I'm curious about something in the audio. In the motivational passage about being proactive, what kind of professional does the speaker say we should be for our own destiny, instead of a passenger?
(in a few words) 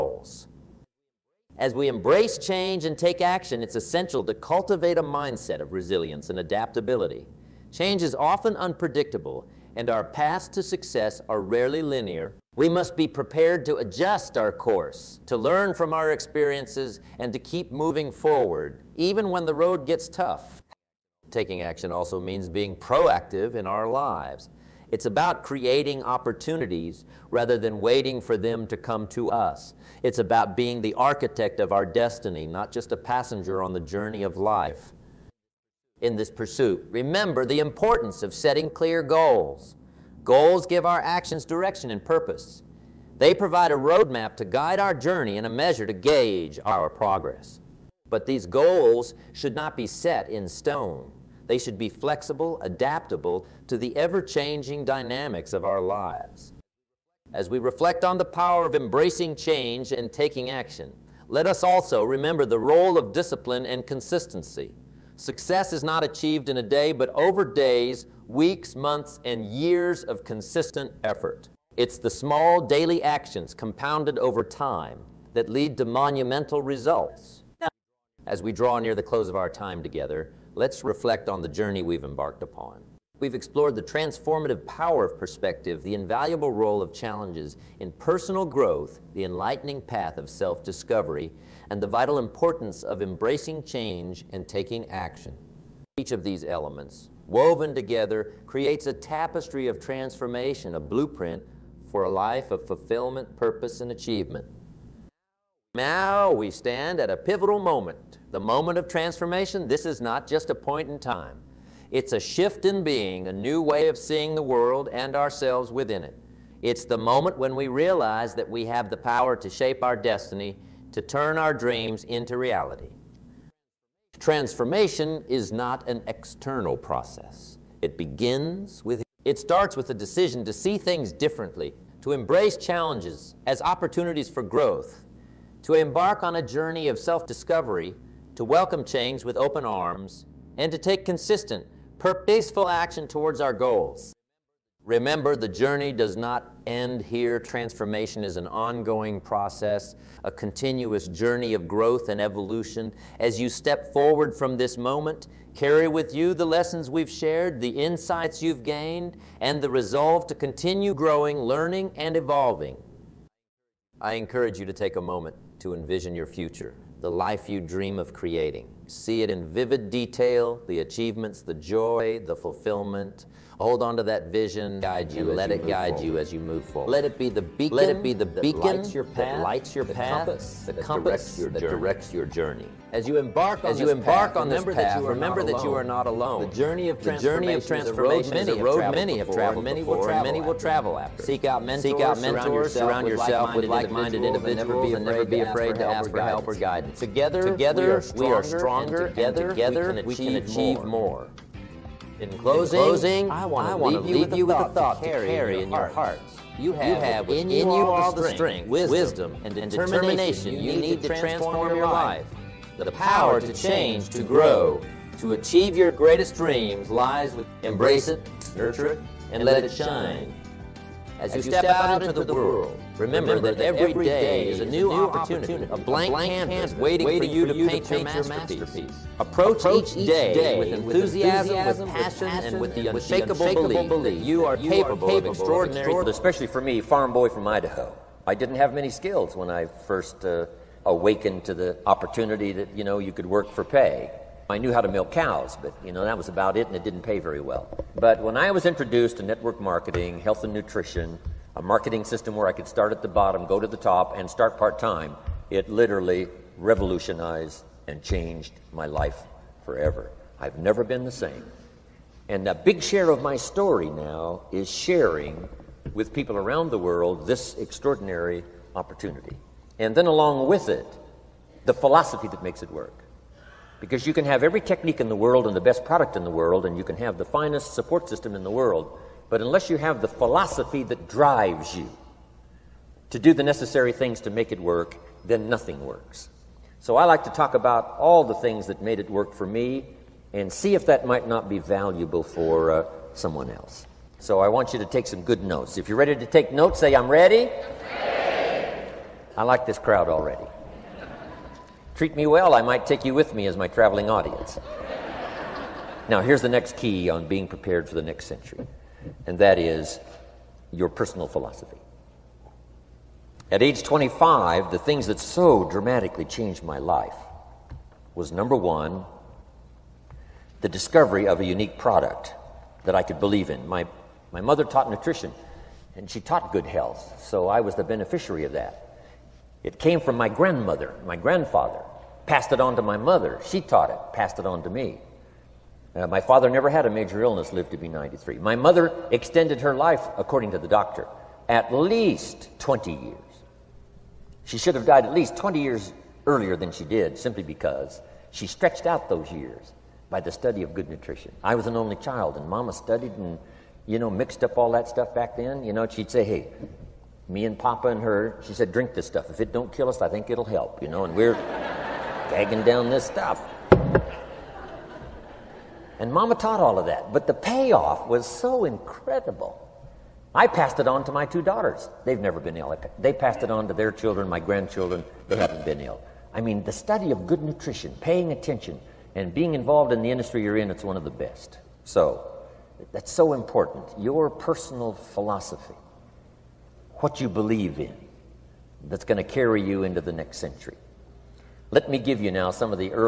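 architect.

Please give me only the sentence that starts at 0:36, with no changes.
Remember the importance of setting clear goals.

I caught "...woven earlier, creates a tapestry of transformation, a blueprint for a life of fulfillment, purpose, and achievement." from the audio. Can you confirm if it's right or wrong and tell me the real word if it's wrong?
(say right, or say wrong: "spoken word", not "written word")
wrong: "together", not "earlier".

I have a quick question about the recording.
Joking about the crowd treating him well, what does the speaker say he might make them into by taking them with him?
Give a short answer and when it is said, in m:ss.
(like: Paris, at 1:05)
traveling audience, at 5:03.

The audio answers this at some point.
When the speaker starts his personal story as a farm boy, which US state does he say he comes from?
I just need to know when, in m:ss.
3:57.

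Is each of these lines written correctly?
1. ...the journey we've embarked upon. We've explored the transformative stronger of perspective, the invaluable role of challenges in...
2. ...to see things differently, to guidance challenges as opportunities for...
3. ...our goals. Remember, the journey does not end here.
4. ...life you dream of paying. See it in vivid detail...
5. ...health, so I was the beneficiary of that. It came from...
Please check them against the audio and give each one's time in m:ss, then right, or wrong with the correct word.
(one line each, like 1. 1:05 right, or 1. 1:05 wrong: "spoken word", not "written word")
1. 1:21 wrong: "power", not "stronger"
2. 2:10 wrong: "embrace", not "guidance"
3. 2:23 right
4. 2:47 wrong: "creating", not "paying"
5. 5:26 right.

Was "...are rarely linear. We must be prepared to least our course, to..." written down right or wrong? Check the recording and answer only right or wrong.
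wrong.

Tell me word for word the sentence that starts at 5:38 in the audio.
My mother extended her life, according to the doctor, at least 20 years.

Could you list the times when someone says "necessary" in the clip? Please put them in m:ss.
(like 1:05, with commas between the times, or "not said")
4:43.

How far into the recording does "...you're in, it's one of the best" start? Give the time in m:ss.
6:20.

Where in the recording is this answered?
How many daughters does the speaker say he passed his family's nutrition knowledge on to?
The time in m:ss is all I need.
6:11.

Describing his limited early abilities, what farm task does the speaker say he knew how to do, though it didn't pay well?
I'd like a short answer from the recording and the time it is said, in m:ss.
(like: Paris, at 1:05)
milk cows, at 4:04.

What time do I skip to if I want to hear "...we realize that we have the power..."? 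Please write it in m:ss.
1:57.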